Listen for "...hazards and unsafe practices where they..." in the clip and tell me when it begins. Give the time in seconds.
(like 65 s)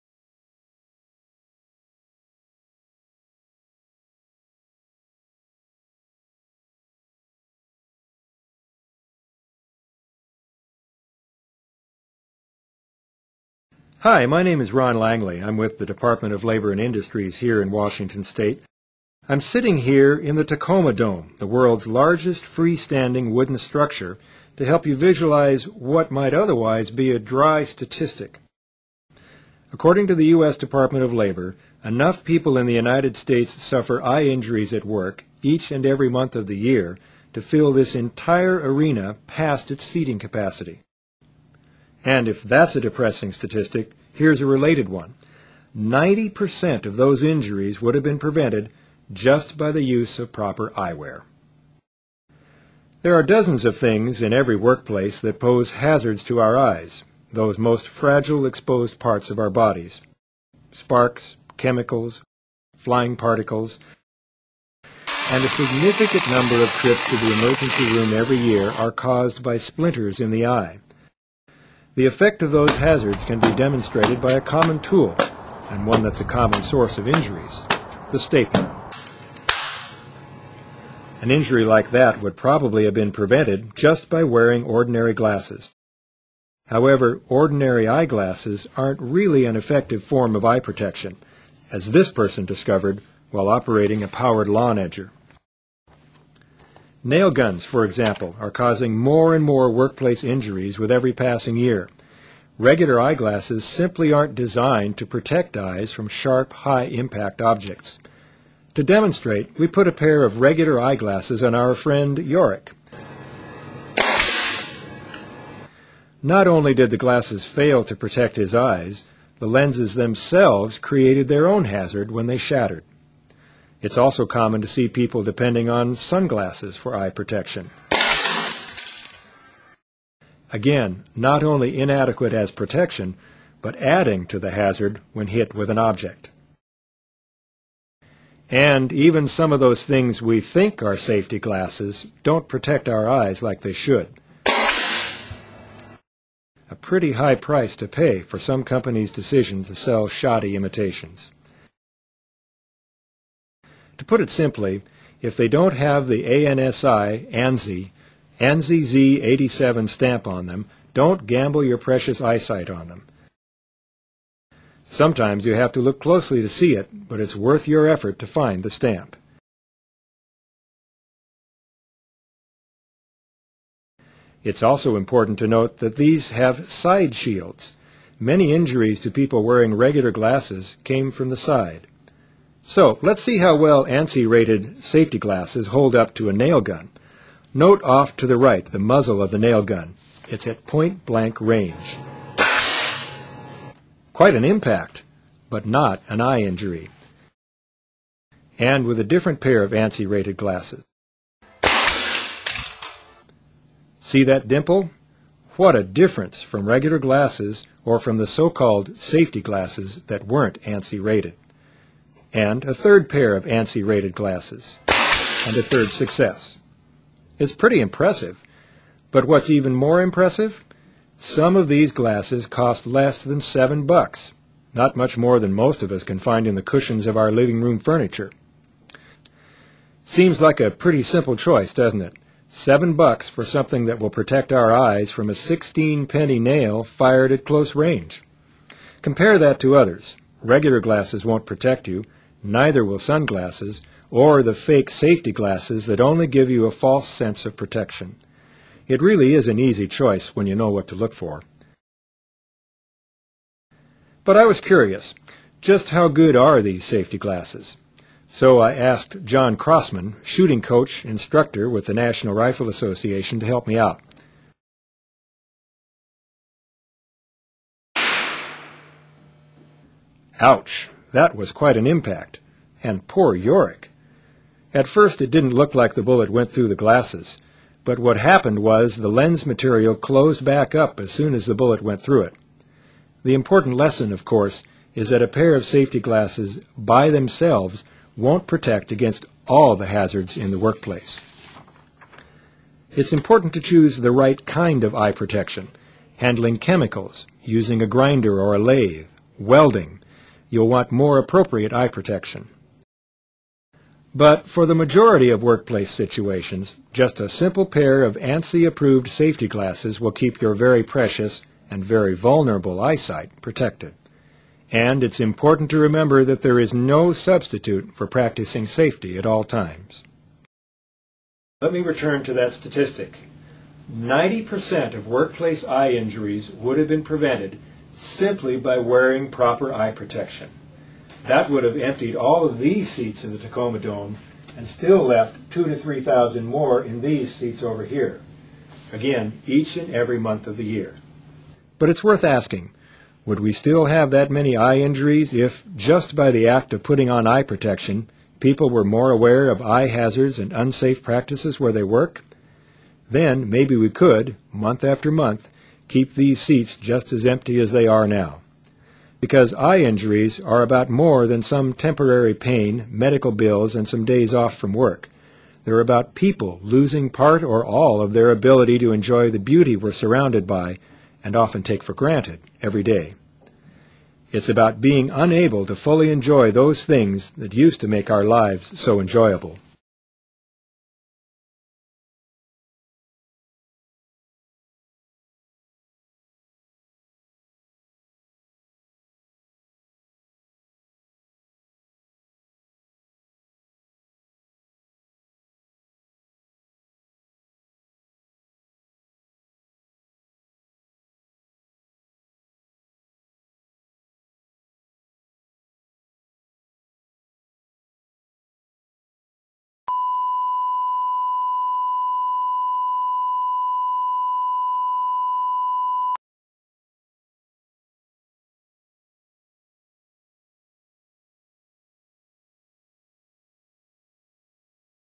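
349 s.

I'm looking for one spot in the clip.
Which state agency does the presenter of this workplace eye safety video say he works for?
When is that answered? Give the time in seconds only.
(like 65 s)
15 s.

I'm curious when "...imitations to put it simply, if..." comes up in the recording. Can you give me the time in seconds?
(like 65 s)
150 s.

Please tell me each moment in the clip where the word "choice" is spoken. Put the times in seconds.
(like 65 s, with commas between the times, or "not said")
231 s, 249 s.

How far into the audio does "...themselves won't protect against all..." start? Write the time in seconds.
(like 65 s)
287 s.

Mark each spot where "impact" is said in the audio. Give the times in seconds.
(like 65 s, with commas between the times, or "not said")
106 s, 194 s, 271 s.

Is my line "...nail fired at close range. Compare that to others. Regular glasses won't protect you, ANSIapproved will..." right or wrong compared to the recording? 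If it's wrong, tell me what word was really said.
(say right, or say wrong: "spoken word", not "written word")
wrong: "Neither", not "ANSIapproved".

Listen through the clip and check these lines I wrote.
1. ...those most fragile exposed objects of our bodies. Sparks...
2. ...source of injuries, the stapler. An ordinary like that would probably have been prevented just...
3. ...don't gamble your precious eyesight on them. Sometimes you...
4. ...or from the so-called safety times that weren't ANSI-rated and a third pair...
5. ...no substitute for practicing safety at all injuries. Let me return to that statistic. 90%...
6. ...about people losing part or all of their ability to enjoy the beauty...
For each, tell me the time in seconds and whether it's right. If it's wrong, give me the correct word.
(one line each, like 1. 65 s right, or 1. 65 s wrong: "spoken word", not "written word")
1. 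57 s wrong: "parts", not "objects"
2. 76 s wrong: "injury", not "ordinary"
3. 160 s right
4. 207 s wrong: "glasses", not "times"
5. 316 s wrong: "times", not "injuries"
6. 365 s right.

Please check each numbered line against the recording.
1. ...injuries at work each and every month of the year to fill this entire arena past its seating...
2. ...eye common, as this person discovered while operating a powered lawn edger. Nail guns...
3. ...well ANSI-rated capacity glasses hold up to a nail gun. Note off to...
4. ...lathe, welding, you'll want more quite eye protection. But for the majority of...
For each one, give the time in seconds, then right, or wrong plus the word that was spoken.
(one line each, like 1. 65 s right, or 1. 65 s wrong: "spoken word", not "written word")
1. 34 s right
2. 90 s wrong: "protection", not "common"
3. 183 s wrong: "safety", not "capacity"
4. 298 s wrong: "appropriate", not "quite".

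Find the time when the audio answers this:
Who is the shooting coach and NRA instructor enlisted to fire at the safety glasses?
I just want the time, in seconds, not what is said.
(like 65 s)
259 s.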